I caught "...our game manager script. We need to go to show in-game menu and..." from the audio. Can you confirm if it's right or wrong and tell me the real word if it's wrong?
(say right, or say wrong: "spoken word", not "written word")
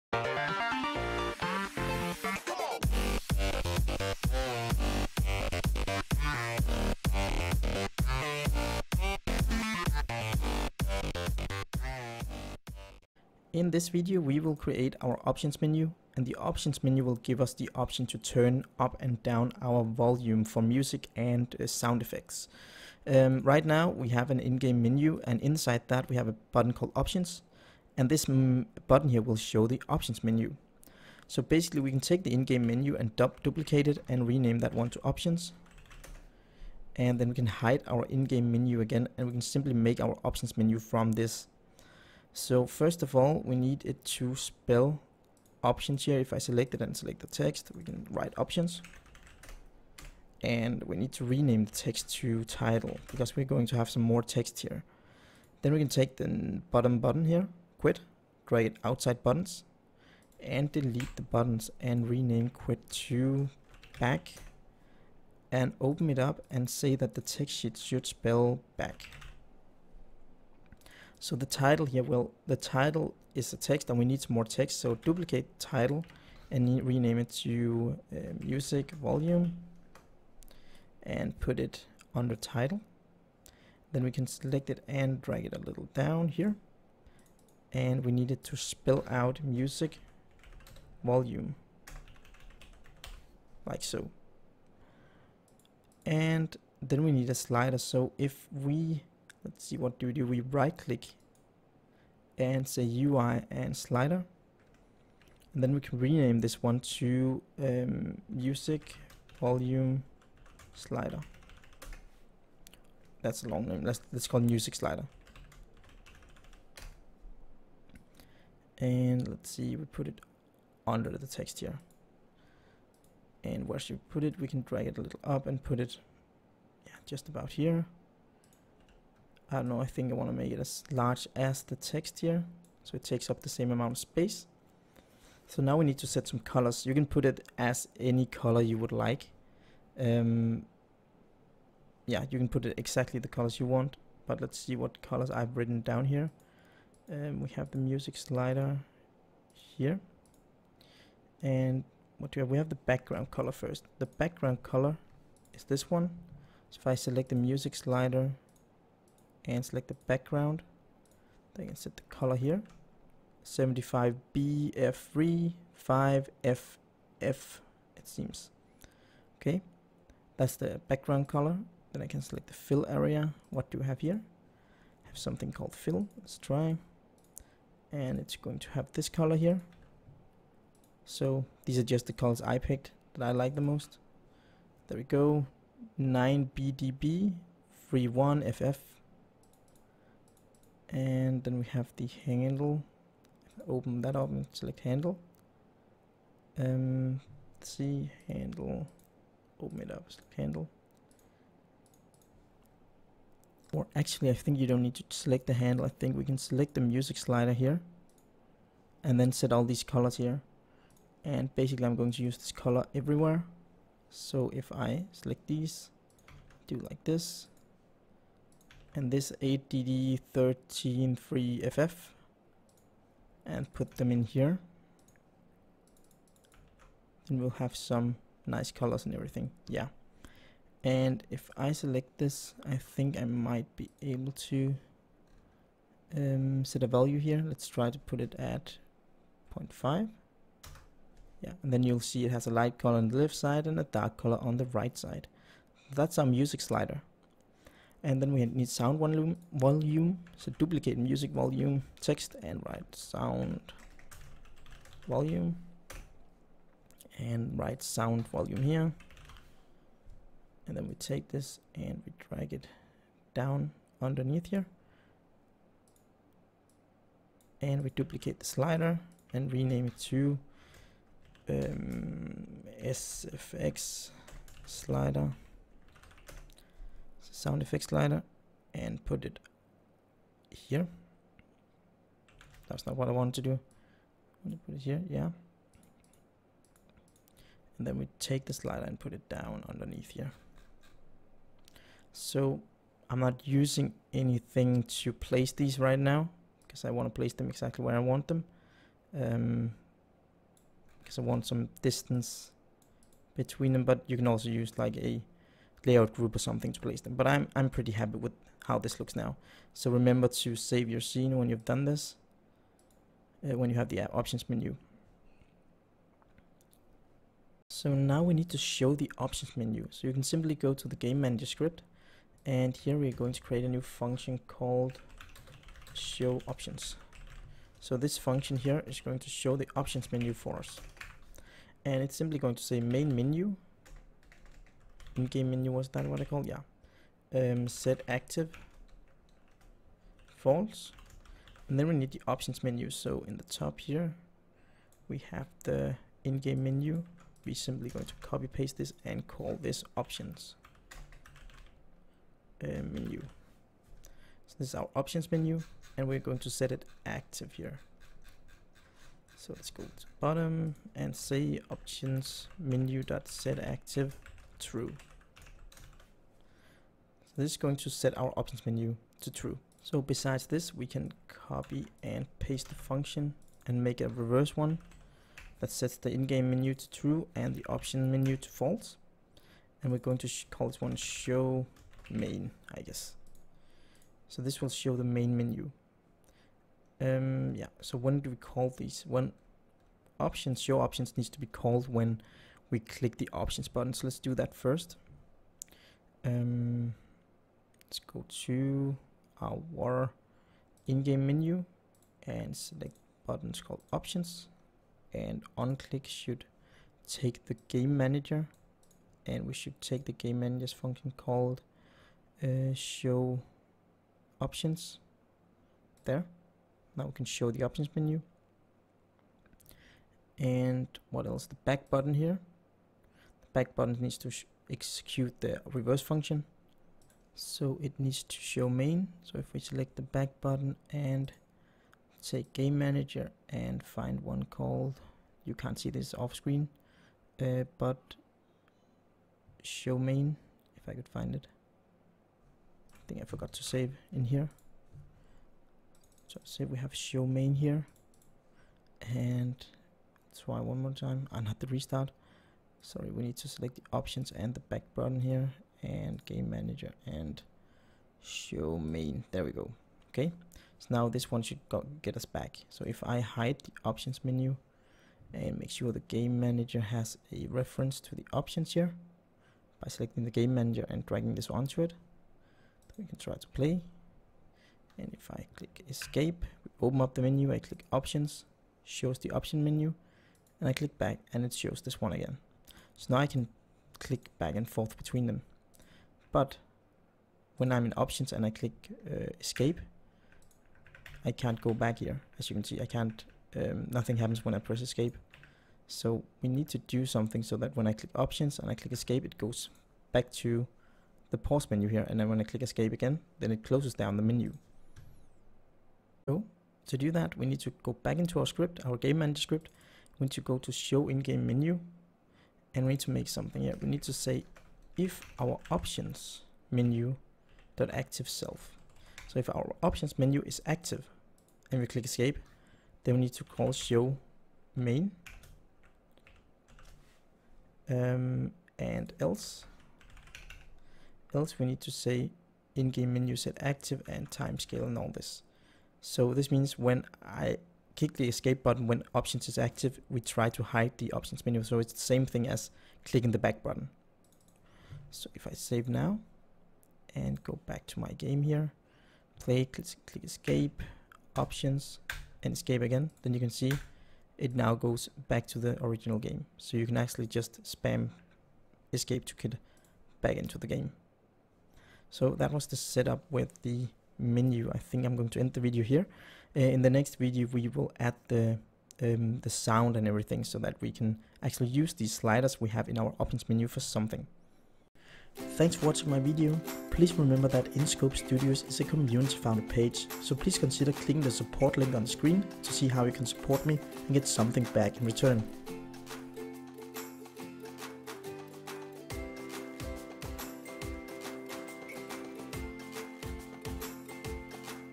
right.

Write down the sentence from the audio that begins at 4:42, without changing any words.
That's not what I wanted to do.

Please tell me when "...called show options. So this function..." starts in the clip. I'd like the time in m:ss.
5:24.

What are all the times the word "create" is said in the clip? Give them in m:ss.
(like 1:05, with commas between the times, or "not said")
0:14, 0:58, 5:23.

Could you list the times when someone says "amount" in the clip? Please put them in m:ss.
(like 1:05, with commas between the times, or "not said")
2:13.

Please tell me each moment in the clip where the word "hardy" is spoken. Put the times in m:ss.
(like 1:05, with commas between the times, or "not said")
not said.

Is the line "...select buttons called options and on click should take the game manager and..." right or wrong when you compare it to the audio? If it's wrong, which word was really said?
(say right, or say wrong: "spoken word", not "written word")
right.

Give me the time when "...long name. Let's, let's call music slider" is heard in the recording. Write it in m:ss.
1:53.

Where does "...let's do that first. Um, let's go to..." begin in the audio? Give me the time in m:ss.
6:34.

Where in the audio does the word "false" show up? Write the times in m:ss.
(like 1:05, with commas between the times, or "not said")
5:40, 6:18.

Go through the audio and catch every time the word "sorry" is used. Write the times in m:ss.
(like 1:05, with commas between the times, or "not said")
7:32.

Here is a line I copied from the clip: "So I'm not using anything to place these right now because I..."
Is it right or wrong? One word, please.
right.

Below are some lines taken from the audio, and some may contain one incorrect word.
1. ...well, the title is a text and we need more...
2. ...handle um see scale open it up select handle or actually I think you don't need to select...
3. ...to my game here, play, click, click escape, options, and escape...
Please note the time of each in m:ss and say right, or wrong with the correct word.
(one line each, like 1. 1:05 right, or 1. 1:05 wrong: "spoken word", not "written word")
1. 1:12 right
2. 3:14 wrong: "handle", not "scale"
3. 9:07 right.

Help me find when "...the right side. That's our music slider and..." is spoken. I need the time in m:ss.
4:04.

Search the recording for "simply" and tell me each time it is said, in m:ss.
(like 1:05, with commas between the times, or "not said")
0:39, 5:20, 5:32, 5:47.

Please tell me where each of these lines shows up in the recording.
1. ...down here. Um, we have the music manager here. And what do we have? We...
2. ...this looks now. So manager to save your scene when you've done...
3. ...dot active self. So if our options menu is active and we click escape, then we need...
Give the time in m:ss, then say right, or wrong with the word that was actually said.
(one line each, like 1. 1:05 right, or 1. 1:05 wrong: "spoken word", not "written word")
1. 2:25 wrong: "slider", not "manager"
2. 5:08 wrong: "remember", not "manager"
3. 8:37 right.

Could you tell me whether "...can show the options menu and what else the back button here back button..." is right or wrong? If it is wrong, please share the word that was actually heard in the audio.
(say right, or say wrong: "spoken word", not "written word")
right.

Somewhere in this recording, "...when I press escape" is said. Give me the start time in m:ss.
8:14.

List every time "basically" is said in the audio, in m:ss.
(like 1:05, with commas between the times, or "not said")
0:31, 3:31.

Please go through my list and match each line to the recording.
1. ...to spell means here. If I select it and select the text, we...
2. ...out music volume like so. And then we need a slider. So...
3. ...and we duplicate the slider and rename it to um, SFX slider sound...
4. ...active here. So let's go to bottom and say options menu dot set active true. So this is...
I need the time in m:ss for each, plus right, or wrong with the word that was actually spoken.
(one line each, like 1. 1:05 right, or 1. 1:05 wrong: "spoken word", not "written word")
1. 0:44 wrong: "options", not "means"
2. 1:29 right
3. 4:27 right
4. 5:57 right.